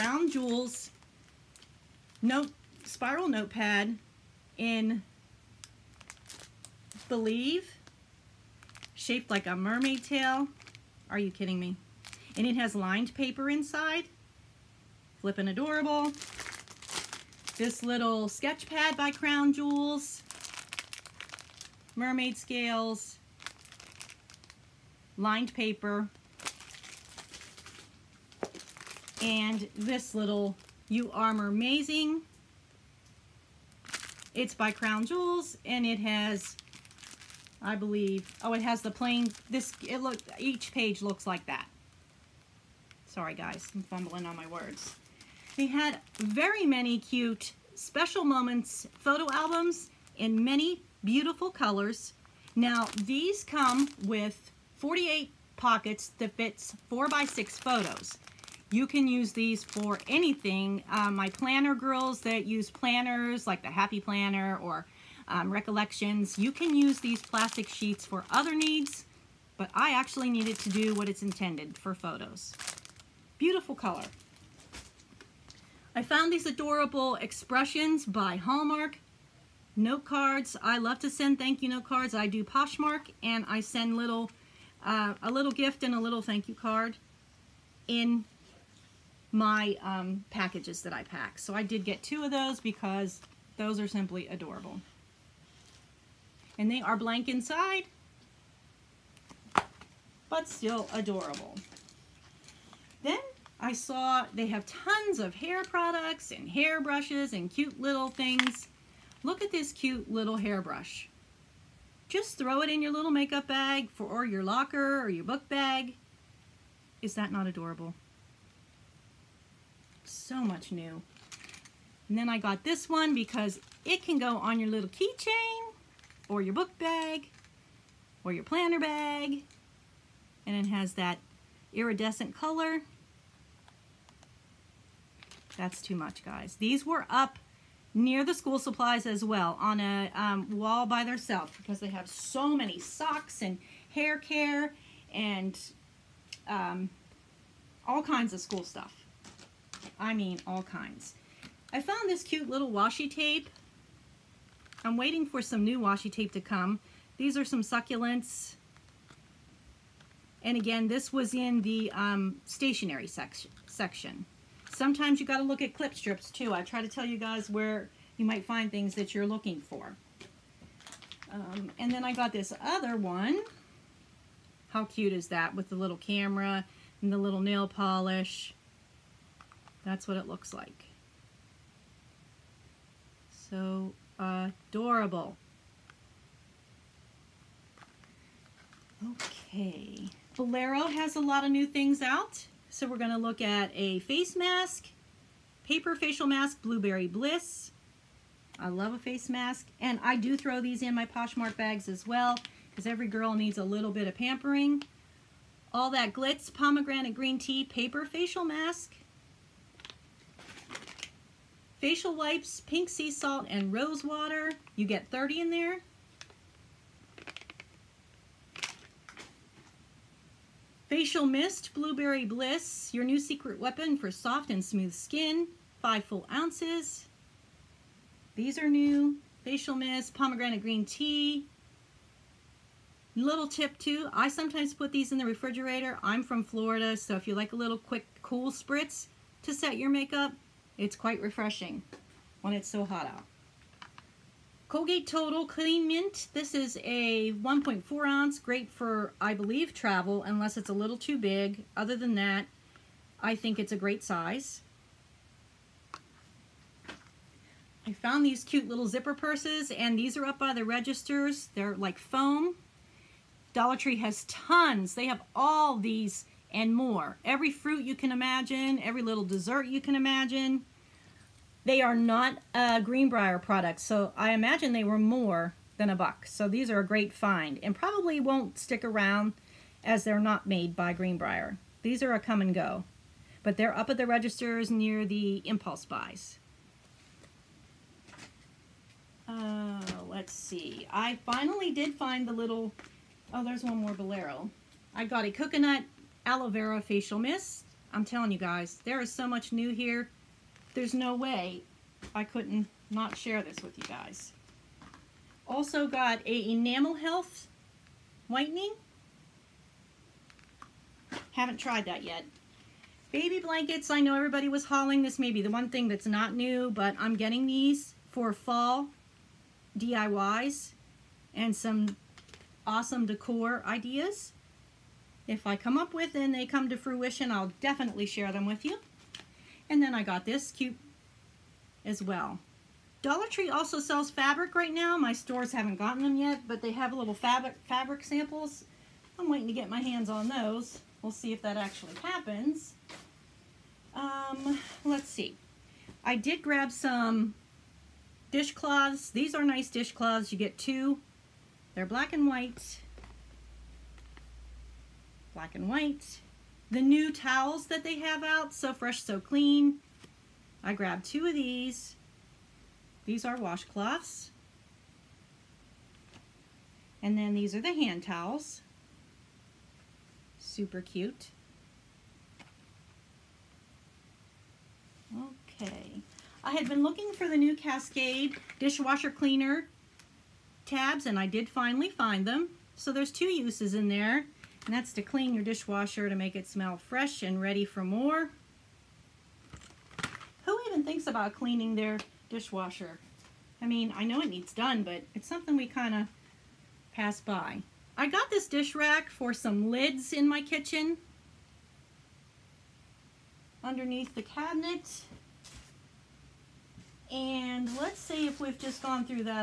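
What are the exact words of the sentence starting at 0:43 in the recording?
Sorry, guys, I'm fumbling on my words.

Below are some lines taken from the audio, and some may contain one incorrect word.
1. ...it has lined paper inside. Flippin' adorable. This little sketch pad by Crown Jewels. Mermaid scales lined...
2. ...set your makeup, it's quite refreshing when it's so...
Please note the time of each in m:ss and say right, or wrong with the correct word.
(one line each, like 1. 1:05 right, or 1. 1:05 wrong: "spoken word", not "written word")
1. 0:12 right
2. 3:59 right.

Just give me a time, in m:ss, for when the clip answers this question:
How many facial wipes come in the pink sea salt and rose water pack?
3:35.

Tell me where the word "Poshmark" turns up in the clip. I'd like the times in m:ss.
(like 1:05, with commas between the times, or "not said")
1:22, 3:21.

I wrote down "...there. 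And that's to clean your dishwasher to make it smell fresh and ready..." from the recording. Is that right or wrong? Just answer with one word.
right.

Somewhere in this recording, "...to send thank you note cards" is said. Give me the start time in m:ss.
1:20.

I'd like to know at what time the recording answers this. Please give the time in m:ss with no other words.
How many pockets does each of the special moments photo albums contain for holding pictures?
0:54.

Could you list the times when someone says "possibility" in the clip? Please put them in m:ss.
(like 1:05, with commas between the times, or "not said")
not said.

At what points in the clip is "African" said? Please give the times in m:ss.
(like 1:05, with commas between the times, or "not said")
not said.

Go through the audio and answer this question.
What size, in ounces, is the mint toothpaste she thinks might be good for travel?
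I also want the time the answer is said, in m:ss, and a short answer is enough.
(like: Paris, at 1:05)
1.4 ounces, at 4:07.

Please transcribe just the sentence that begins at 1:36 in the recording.
And they are blank inside, but still adorable.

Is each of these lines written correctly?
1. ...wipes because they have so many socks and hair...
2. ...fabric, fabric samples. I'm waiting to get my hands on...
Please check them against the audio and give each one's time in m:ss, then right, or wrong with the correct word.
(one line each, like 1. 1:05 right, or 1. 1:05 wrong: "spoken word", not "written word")
1. 2:21 wrong: "themselves", not "wipes"
2. 5:37 right.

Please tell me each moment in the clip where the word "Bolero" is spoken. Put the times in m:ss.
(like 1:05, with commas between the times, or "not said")
3:10, 4:53.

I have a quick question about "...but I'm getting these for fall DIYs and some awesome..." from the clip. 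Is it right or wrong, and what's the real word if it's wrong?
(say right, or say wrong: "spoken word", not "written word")
right.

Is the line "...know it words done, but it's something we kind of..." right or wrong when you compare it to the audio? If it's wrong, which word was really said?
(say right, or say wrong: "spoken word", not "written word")
wrong: "needs", not "words".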